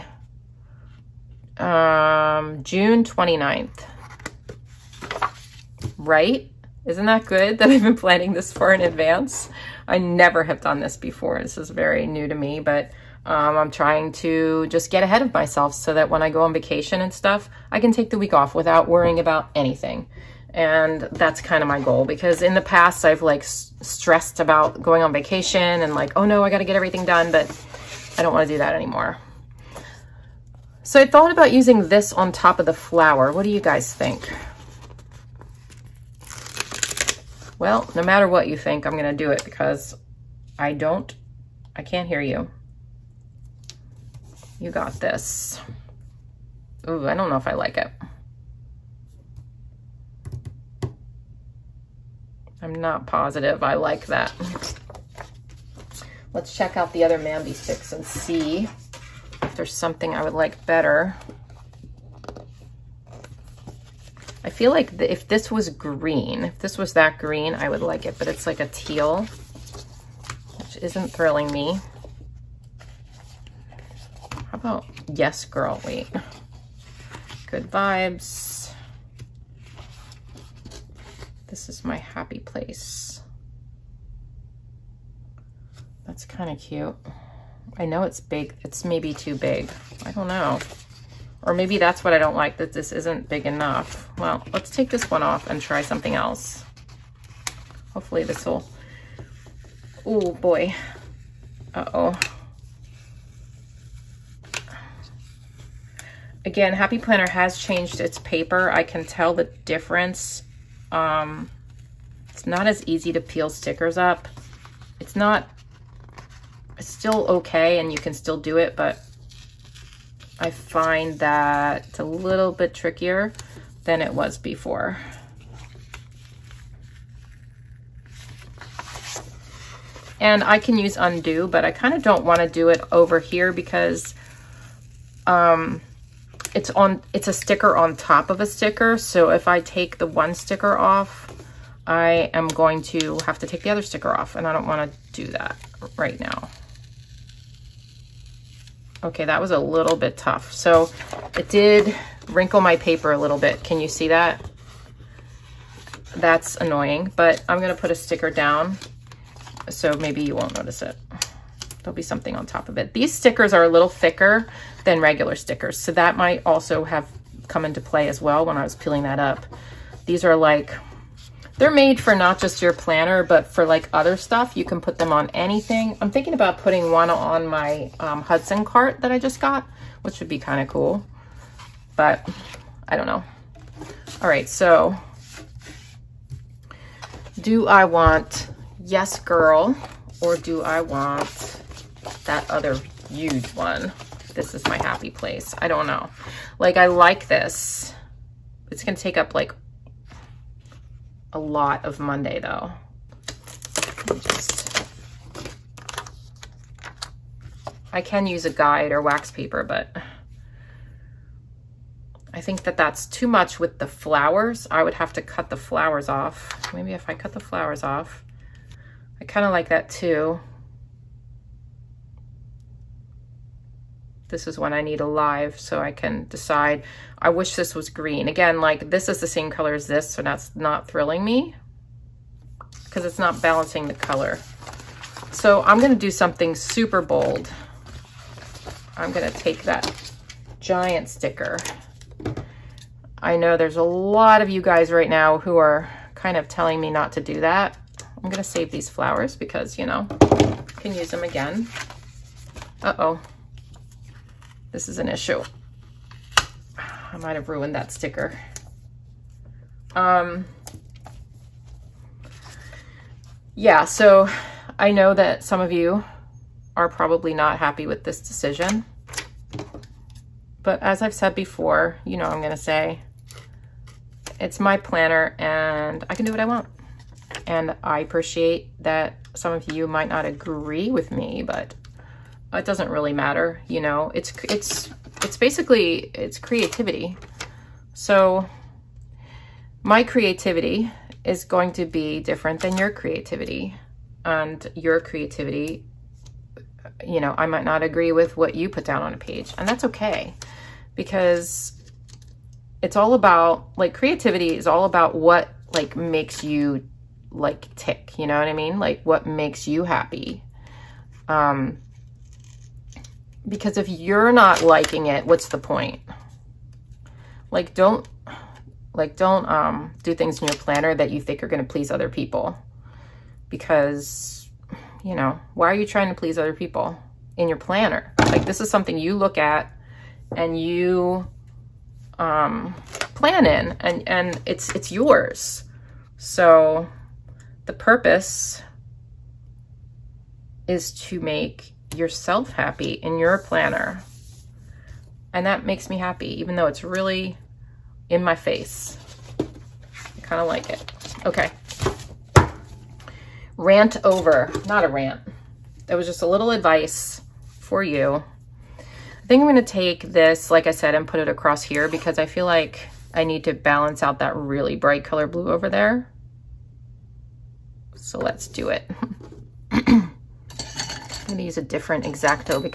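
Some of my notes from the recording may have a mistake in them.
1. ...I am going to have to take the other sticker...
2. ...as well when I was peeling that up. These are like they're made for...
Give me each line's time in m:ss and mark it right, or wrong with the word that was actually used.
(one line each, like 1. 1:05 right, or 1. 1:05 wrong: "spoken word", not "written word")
1. 2:21 right
2. 2:48 right.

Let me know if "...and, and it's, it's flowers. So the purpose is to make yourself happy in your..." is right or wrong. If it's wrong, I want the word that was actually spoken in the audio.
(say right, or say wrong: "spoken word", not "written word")
wrong: "yours", not "flowers".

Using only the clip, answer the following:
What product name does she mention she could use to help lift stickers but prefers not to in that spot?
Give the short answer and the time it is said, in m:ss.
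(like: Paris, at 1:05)
Un-du, at 2:10.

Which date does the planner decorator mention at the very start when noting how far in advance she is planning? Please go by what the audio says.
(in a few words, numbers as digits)
June 29th.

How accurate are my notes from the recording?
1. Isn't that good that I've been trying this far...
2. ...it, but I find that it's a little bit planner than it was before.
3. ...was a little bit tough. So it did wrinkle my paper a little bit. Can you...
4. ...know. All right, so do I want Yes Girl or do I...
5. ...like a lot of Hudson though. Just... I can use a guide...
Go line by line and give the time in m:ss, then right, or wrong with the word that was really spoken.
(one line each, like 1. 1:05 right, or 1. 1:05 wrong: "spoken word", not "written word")
1. 0:06 wrong: "planning", not "trying"
2. 1:58 wrong: "trickier", not "planner"
3. 2:29 right
4. 3:03 right
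5. 3:19 wrong: "Monday", not "Hudson".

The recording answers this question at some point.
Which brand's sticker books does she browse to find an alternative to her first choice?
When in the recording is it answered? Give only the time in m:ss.
0:57.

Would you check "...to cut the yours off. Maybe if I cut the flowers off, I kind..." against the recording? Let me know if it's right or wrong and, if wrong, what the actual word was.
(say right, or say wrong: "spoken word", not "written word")
wrong: "flowers", not "yours".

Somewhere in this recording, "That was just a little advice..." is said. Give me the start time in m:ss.
5:55.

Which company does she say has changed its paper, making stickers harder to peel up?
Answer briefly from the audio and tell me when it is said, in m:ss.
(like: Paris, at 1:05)
Happy Planner, at 1:46.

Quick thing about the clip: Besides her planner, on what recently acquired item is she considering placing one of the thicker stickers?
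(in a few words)
Hudson cart.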